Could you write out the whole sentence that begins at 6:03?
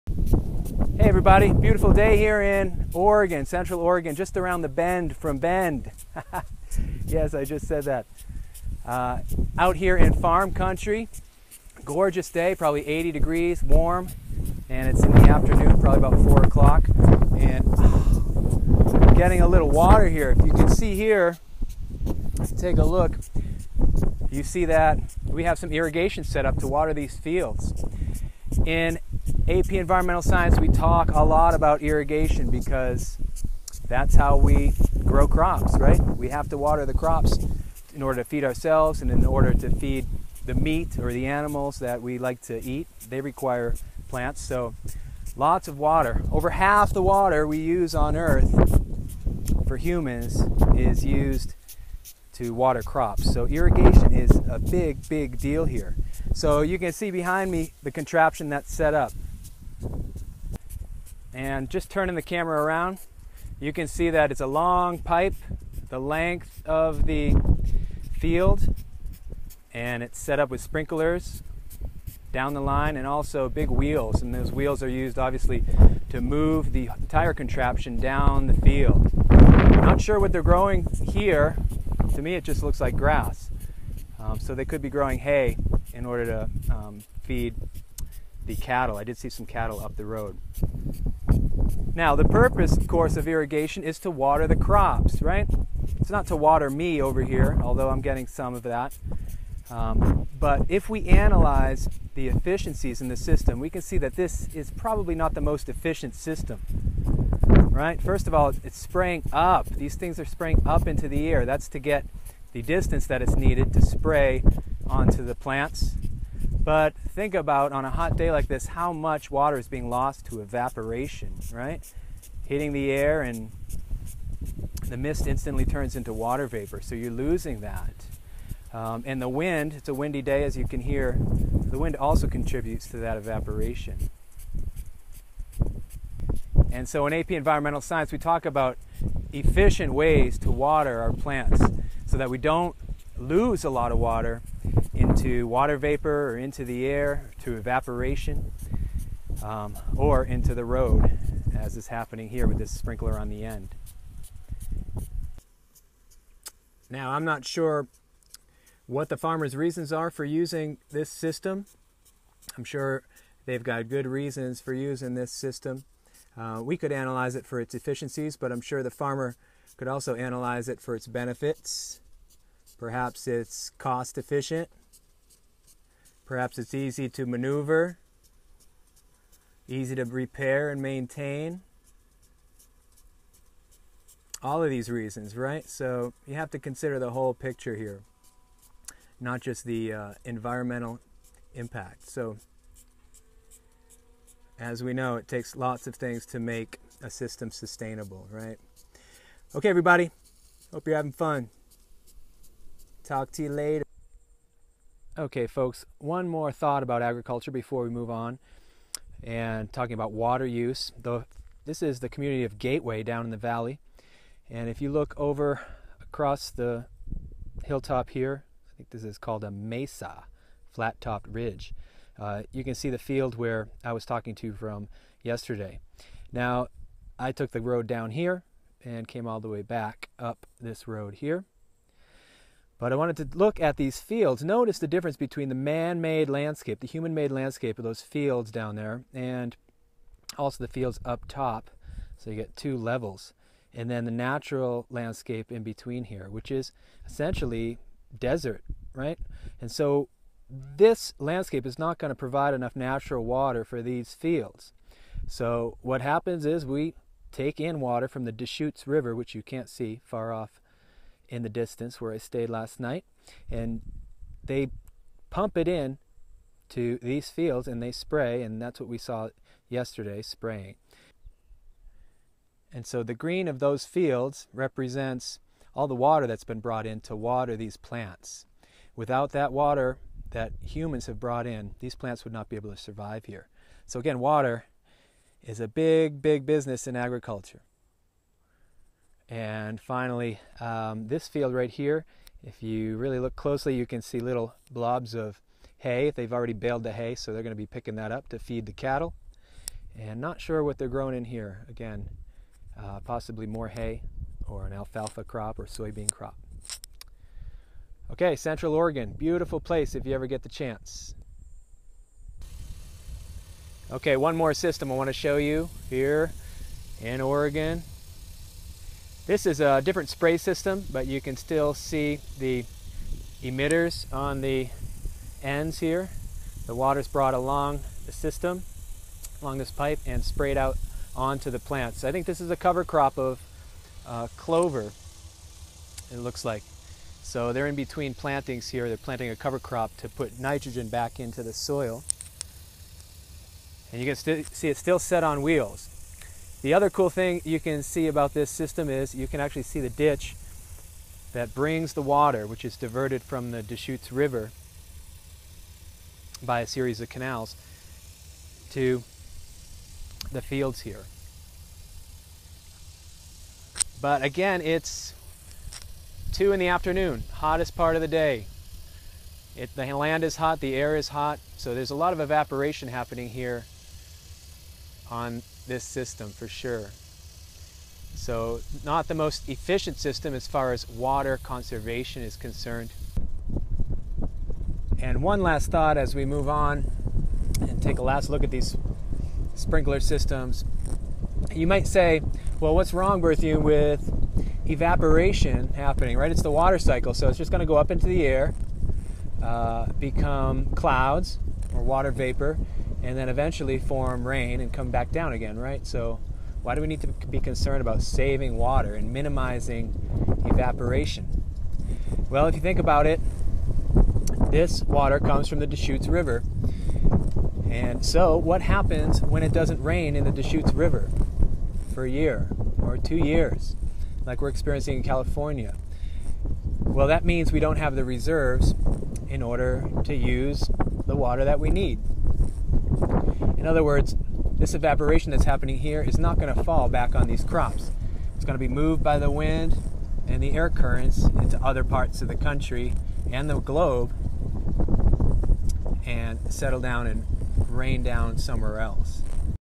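But again, it's 2 in the afternoon, hottest part of the day.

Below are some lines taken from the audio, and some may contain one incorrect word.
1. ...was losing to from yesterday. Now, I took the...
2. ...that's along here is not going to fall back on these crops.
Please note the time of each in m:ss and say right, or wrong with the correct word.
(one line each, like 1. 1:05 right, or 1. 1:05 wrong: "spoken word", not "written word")
1. 3:43 wrong: "talking", not "losing"
2. 7:15 wrong: "happening", not "along".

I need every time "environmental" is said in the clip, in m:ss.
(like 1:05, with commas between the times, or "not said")
0:29, 2:17, 3:10.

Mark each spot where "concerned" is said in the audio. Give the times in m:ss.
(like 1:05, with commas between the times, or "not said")
6:22, 6:47.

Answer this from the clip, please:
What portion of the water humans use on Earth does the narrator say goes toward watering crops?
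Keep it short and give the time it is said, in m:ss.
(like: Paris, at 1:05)
Over half, at 0:46.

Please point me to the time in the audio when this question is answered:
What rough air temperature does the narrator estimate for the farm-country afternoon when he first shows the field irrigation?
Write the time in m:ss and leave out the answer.
0:12.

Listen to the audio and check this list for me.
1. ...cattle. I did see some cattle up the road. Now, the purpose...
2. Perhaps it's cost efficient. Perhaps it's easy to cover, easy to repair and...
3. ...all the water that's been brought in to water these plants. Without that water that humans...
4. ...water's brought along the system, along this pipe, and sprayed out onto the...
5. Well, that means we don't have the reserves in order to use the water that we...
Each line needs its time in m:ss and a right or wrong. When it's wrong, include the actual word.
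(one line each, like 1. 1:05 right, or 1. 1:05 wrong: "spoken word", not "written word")
1. 1:28 right
2. 2:52 wrong: "maneuver", not "cover"
3. 4:35 right
4. 5:26 right
5. 7:06 right.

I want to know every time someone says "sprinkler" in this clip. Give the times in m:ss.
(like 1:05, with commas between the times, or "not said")
1:10, 2:32, 6:29.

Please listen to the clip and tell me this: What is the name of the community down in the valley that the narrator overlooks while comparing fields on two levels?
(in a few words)
Gateway.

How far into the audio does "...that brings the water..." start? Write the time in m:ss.
5:51.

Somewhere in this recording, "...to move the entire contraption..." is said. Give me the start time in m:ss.
1:16.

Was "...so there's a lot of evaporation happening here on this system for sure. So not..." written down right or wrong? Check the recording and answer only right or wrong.
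right.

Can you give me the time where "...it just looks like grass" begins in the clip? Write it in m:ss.
1:22.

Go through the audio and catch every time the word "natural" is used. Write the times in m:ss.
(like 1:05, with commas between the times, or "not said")
4:04, 4:12.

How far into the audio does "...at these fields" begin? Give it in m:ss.
3:53.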